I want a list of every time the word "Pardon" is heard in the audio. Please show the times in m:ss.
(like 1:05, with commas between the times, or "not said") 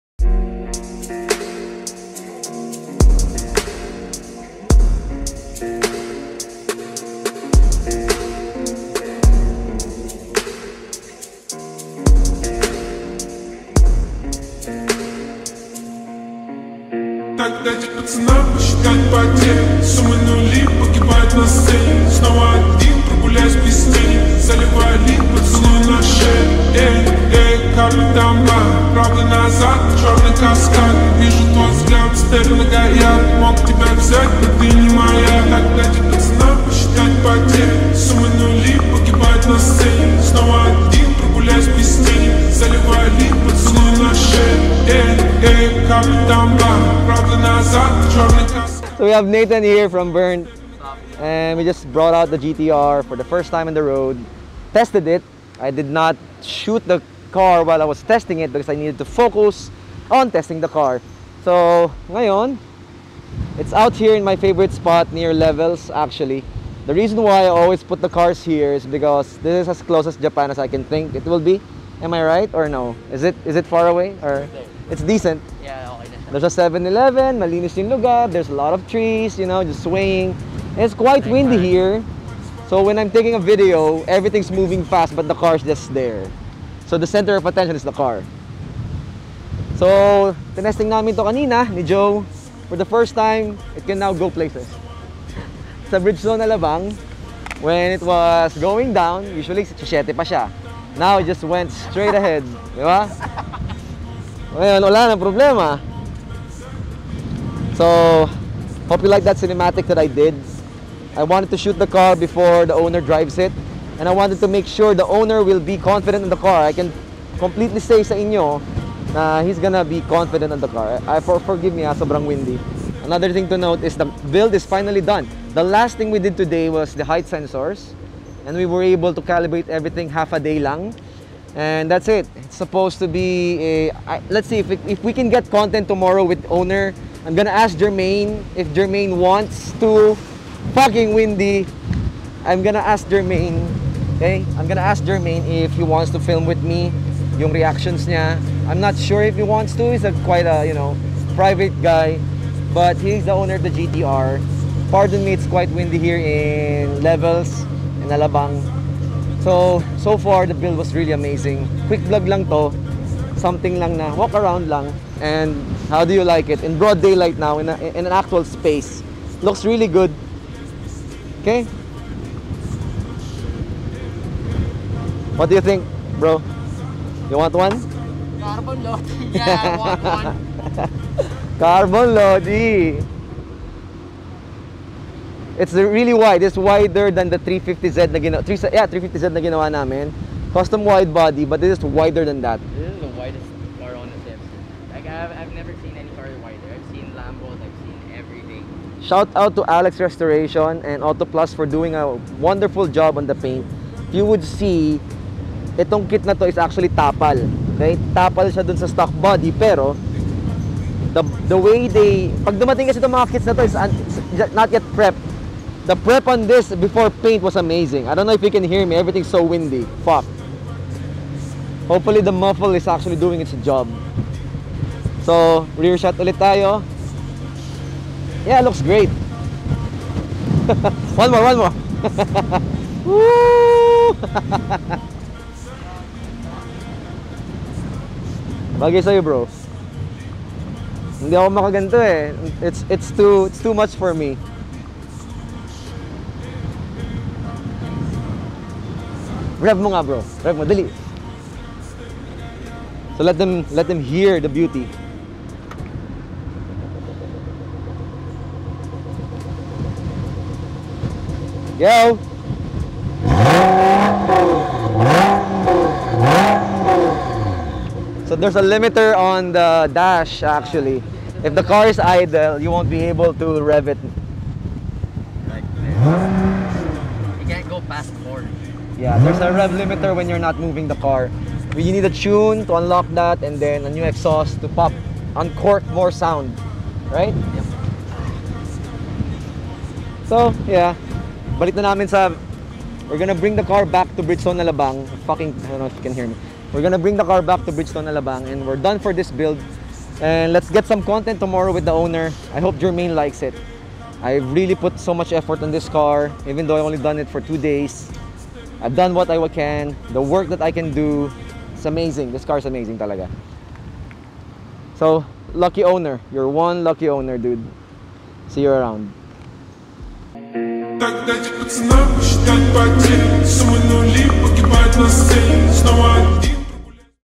2:34.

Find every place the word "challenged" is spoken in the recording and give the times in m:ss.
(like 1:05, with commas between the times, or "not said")
not said.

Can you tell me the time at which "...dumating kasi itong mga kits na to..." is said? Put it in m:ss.
3:32.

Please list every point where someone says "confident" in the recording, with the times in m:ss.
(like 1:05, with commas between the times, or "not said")
1:55, 2:00.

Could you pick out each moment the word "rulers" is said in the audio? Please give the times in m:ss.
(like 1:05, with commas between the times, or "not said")
not said.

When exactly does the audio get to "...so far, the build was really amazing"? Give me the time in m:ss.
2:40.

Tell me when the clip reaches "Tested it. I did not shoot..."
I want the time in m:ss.
0:54.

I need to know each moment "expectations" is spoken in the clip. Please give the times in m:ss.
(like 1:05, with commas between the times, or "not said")
not said.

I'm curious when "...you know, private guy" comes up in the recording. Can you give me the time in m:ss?
2:30.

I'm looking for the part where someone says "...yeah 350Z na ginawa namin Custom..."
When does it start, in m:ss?
3:08.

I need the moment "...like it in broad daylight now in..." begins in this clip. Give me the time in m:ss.
2:46.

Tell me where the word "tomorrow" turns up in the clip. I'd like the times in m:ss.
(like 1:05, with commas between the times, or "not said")
2:15, 5:01.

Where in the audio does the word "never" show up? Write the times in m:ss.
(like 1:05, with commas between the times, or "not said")
3:15.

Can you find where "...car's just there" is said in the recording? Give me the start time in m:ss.
1:25.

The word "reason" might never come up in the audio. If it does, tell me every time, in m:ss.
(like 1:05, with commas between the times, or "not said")
1:06.